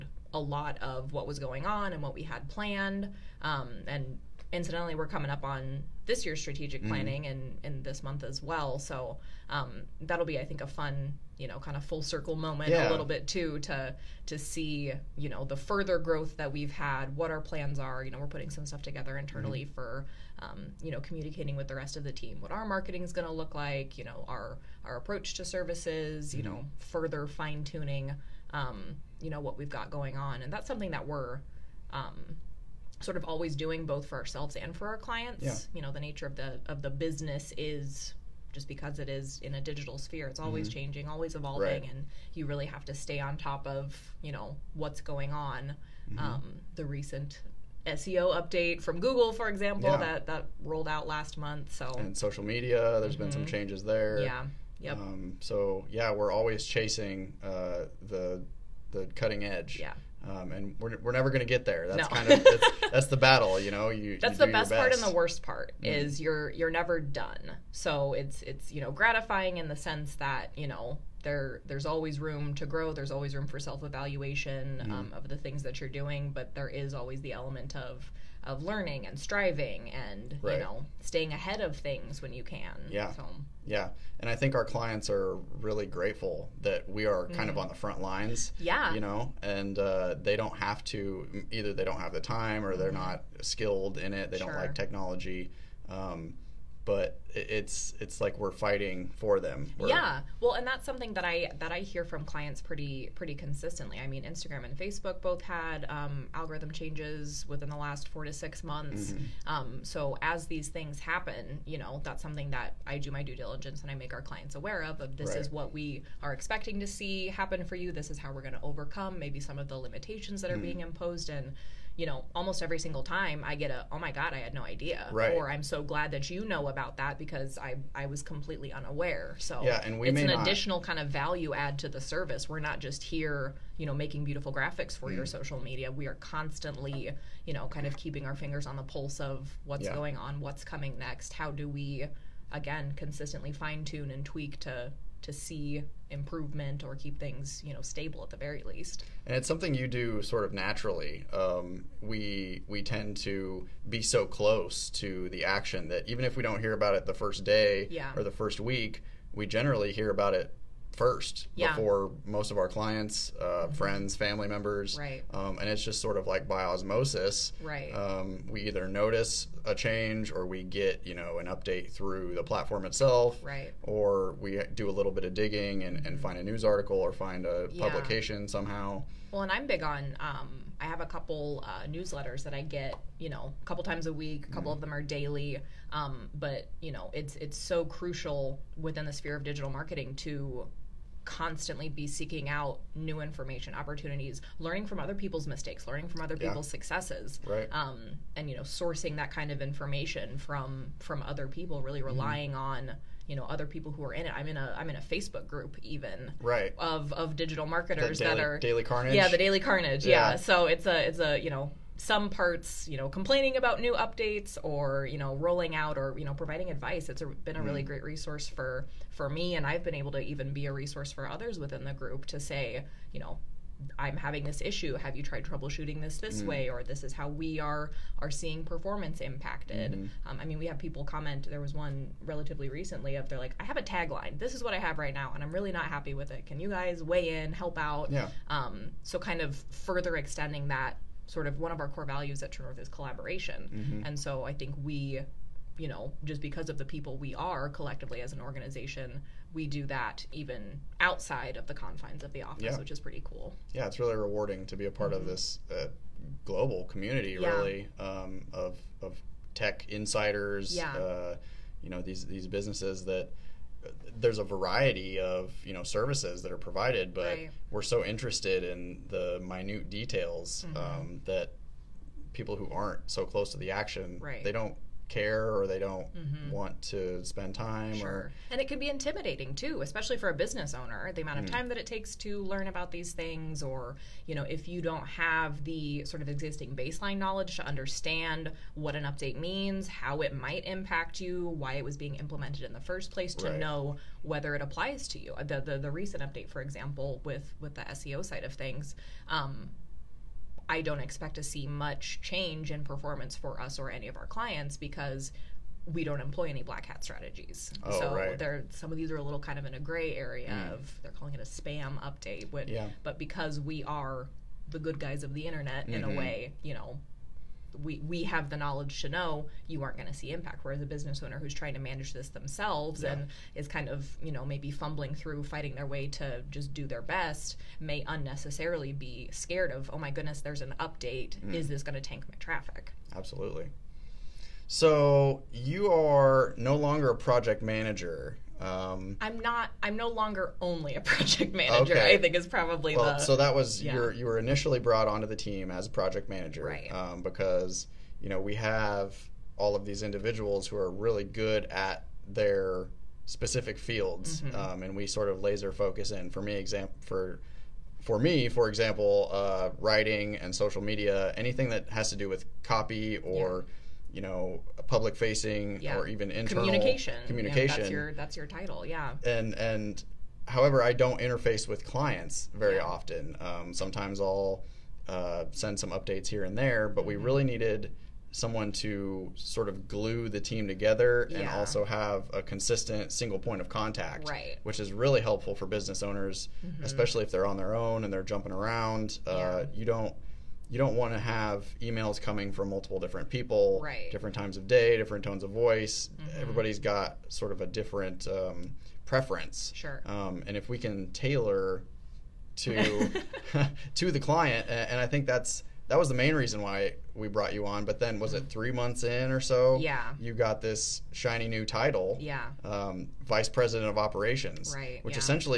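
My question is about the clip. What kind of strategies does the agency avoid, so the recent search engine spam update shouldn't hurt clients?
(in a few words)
Black hat strategies.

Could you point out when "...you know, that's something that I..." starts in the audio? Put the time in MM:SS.
01:51.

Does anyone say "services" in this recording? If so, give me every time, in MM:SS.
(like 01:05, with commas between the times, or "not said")
00:25, 02:11, 04:25.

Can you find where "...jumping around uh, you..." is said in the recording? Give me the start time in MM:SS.
06:28.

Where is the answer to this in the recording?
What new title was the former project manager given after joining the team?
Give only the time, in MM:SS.
06:53.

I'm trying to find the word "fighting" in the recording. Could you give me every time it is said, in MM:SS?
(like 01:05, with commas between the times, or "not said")
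01:38, 05:25.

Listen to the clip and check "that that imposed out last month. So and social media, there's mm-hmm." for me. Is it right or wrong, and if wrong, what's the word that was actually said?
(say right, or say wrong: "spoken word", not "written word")
wrong: "rolled", not "imposed".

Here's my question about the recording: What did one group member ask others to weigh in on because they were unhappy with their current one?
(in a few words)
A tagline.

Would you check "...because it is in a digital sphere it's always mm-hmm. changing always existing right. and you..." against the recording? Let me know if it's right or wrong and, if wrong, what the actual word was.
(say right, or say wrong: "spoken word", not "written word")
wrong: "evolving", not "existing".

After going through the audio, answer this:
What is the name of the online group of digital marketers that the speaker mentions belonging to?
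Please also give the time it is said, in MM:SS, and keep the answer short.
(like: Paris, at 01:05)
The Daily Carnage, at 03:29.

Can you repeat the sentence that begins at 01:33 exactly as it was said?
not skilled in it they sure.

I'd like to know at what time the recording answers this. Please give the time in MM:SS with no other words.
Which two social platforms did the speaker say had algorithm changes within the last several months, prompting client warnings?
01:44.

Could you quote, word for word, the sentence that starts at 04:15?
of this uh, global community, yeah.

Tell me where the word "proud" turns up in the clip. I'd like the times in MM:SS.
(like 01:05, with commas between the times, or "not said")
not said.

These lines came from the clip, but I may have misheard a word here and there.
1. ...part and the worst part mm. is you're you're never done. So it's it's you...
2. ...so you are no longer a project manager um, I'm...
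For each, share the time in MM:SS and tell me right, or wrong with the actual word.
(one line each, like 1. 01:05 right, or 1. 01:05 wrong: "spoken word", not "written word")
1. 01:04 right
2. 05:34 right.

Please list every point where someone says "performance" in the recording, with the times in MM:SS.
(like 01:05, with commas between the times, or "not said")
03:48, 05:02.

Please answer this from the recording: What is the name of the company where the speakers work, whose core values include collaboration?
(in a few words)
True North.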